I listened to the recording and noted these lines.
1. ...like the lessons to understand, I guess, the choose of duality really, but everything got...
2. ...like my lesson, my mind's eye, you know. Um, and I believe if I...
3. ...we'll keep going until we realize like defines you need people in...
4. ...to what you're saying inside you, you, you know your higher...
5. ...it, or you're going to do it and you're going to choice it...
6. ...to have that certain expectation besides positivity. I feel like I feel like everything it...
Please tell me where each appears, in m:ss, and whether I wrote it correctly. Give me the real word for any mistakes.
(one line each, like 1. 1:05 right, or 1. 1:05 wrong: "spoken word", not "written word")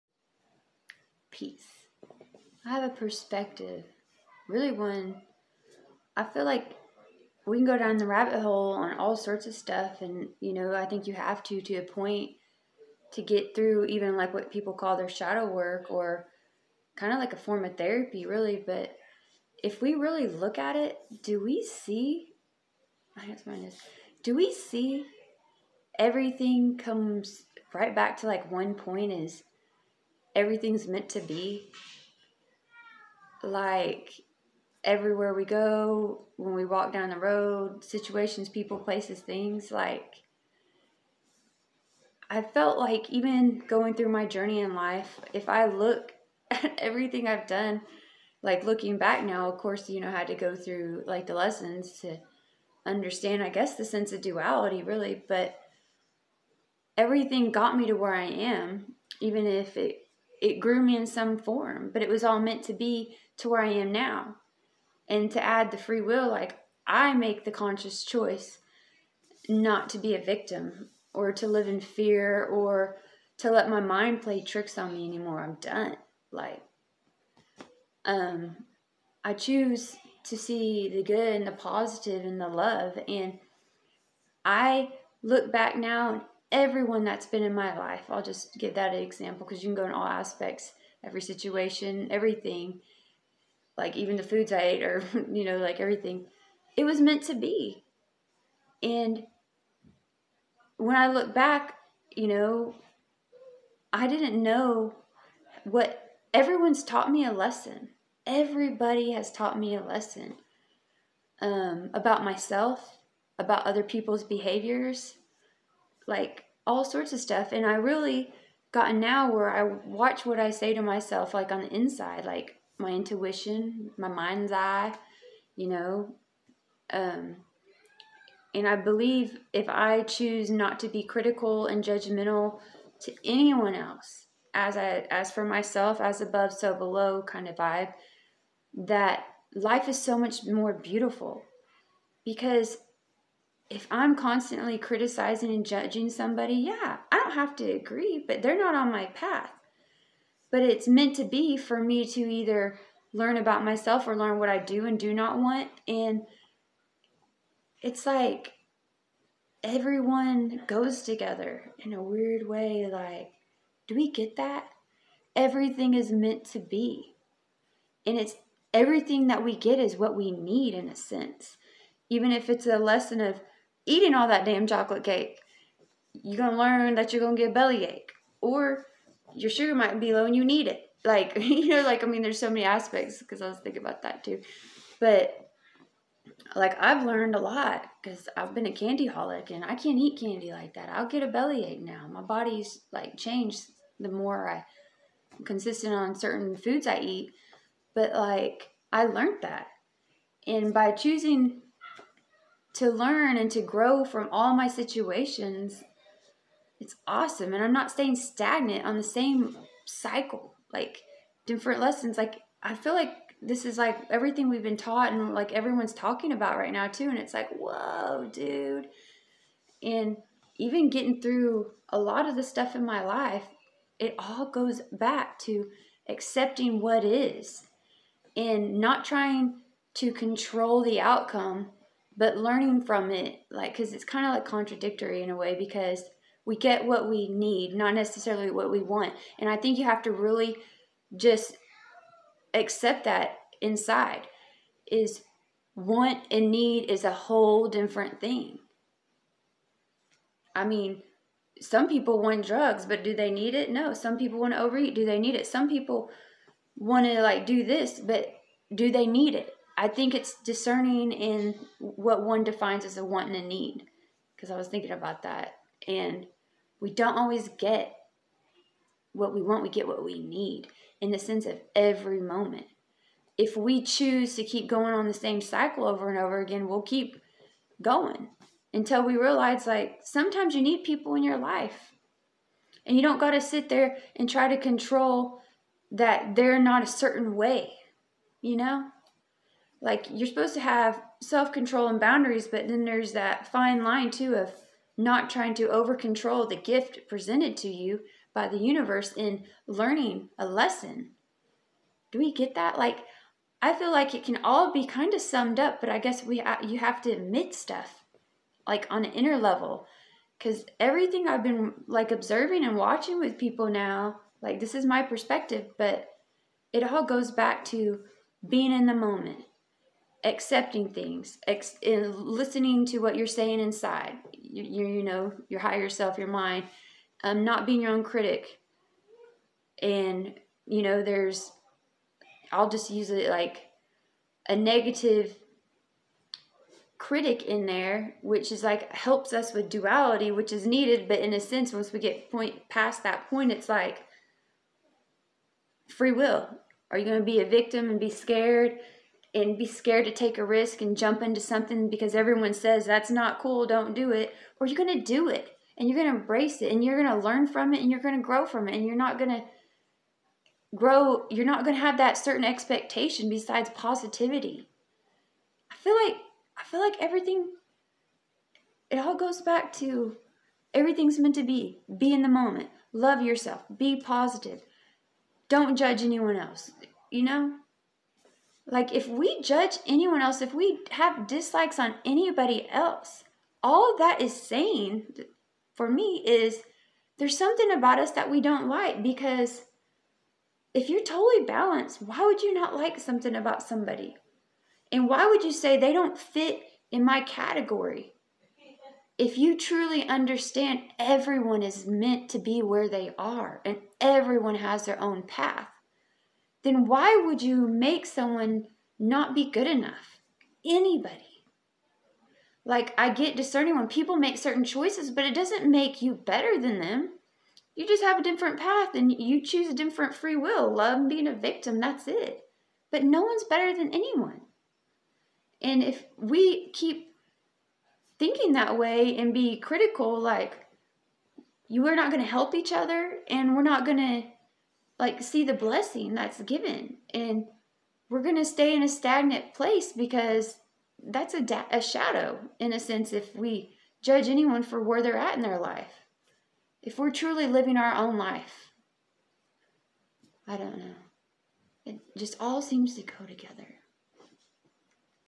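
1. 0:51 wrong: "sense", not "choose"
2. 2:02 wrong: "intuition", not "lesson"
3. 4:36 wrong: "sometimes", not "defines"
4. 5:22 right
5. 5:54 wrong: "embrace", not "choice"
6. 6:01 right.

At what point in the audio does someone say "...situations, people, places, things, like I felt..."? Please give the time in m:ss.
0:37.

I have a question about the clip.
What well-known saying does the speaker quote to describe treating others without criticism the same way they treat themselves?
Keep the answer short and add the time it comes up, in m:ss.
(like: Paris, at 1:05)
as above, so below, at 2:16.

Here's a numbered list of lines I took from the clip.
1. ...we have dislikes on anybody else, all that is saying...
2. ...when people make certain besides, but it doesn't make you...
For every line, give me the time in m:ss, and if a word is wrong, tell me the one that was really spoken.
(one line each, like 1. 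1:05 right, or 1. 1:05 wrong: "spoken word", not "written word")
1. 6:20 right
2. 6:53 wrong: "choices", not "besides".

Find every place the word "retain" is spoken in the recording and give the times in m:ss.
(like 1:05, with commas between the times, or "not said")
not said.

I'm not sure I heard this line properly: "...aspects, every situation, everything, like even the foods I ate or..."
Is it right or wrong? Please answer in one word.
right.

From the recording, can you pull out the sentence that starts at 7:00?
Love being a victim, that's it.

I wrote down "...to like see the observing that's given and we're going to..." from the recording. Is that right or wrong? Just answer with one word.
wrong.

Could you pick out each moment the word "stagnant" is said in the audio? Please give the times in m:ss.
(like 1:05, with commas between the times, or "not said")
3:28, 7:18.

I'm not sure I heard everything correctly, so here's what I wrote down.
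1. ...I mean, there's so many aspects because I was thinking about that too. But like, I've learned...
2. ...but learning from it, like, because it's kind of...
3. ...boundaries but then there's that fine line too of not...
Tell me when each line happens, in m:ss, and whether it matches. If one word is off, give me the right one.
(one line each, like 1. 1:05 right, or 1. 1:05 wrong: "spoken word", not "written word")
1. 3:02 right
2. 3:52 right
3. 4:51 right.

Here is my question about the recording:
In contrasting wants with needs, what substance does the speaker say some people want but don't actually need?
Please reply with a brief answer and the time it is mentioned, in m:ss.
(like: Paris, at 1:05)
drugs, at 4:12.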